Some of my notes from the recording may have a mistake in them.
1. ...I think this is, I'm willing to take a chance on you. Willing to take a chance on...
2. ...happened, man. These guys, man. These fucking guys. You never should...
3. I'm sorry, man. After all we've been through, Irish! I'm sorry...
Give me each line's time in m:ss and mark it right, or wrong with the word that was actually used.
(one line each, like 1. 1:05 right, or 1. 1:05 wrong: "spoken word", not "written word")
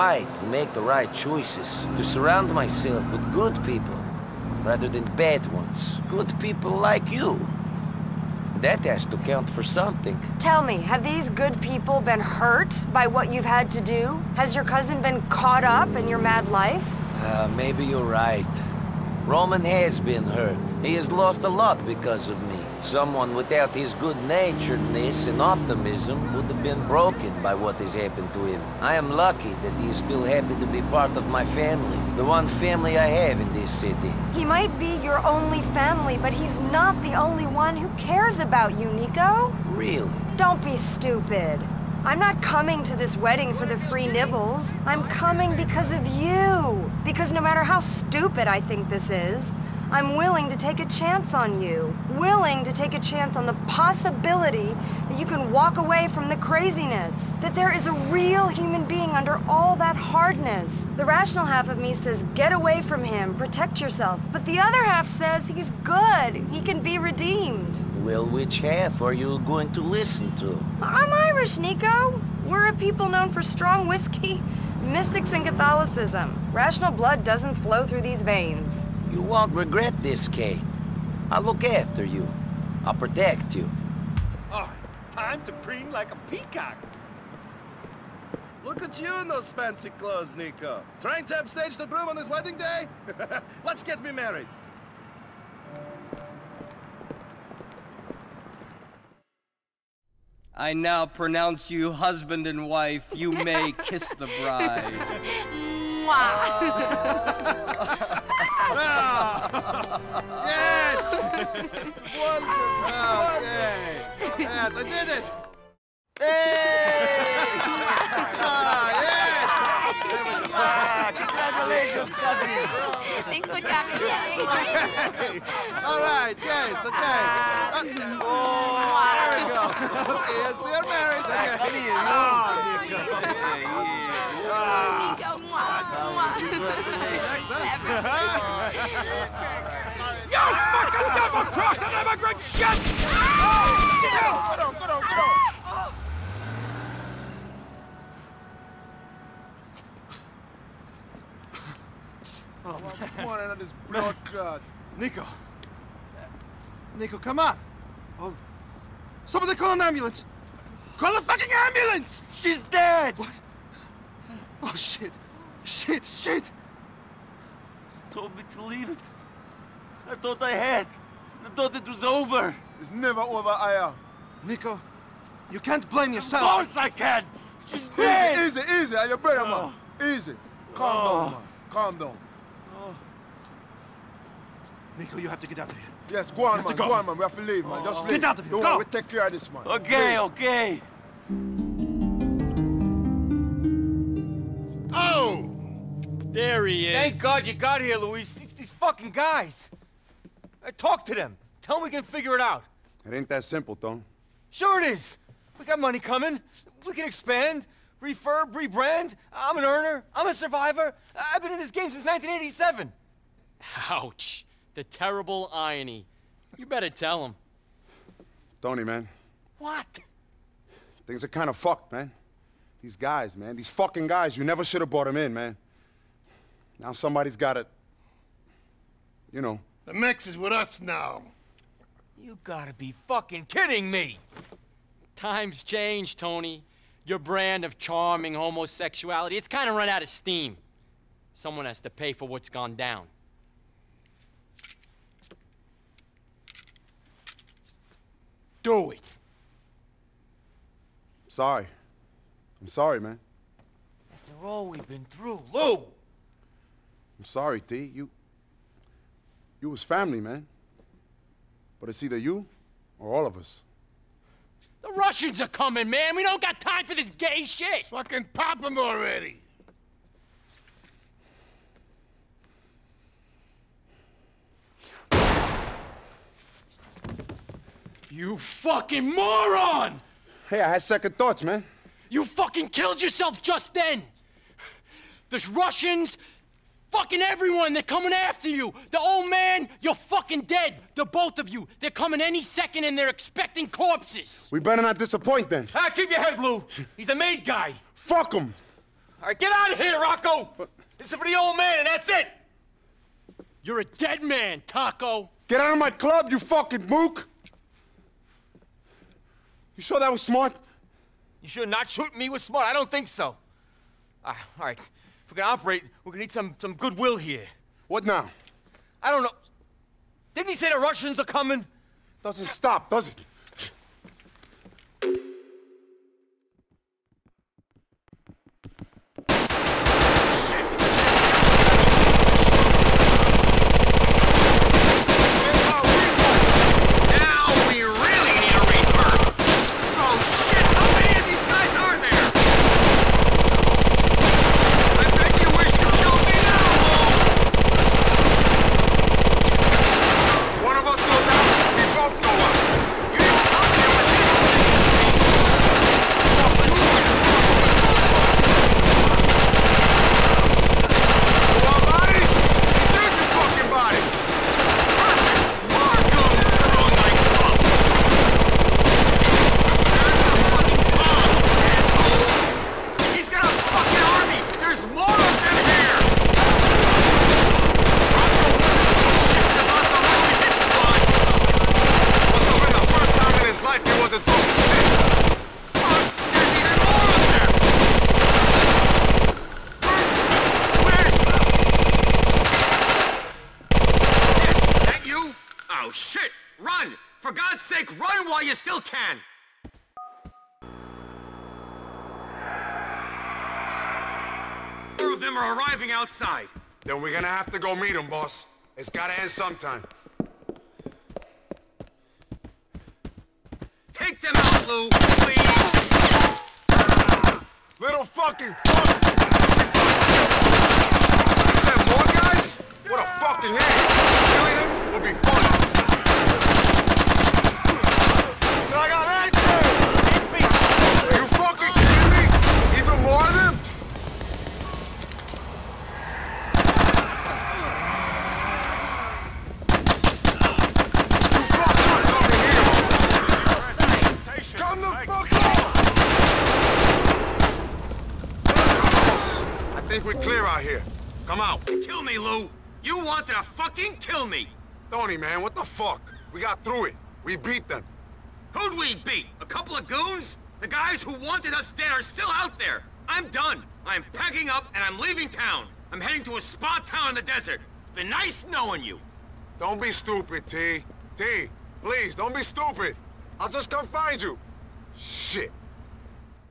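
1. 0:48 right
2. 3:41 wrong: "fucked", not "happened"
3. 4:12 wrong: "Lou", not "Irish".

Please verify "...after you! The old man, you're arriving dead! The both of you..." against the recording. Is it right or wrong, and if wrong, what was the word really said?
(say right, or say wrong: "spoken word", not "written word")
wrong: "fucking", not "arriving".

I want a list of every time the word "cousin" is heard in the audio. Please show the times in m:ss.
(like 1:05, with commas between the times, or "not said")
0:14.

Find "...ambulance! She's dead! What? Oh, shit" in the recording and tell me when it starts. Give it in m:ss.
2:41.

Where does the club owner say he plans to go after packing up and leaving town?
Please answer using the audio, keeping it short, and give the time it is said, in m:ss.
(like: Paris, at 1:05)
a spa town in the desert, at 7:46.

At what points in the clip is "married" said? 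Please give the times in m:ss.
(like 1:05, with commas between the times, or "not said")
1:34, 2:10.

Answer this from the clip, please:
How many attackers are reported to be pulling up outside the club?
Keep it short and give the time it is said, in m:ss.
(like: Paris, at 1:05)
4, at 6:44.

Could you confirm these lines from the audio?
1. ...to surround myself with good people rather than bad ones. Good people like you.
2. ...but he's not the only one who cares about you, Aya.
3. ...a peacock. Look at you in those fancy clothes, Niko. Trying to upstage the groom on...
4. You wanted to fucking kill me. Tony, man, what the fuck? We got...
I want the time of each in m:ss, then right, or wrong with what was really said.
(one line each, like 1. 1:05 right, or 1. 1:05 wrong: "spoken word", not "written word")
1. 0:01 right
2. 0:36 wrong: "Niko", not "Aya"
3. 1:26 right
4. 7:32 right.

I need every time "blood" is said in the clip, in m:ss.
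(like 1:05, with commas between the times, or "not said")
1:16, 2:33.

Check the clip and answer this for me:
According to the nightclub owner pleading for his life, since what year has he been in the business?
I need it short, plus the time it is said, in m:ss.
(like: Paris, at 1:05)
1987, at 3:32.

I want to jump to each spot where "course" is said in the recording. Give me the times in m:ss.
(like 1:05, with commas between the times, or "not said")
2:56.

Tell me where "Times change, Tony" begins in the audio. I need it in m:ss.
3:55.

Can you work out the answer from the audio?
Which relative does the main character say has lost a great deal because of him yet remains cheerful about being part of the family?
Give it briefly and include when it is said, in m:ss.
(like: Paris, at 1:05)
Roman, at 0:19.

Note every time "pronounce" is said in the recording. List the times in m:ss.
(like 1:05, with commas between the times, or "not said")
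1:41.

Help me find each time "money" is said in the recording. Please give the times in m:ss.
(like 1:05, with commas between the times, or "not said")
3:25.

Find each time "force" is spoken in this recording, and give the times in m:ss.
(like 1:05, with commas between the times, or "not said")
not said.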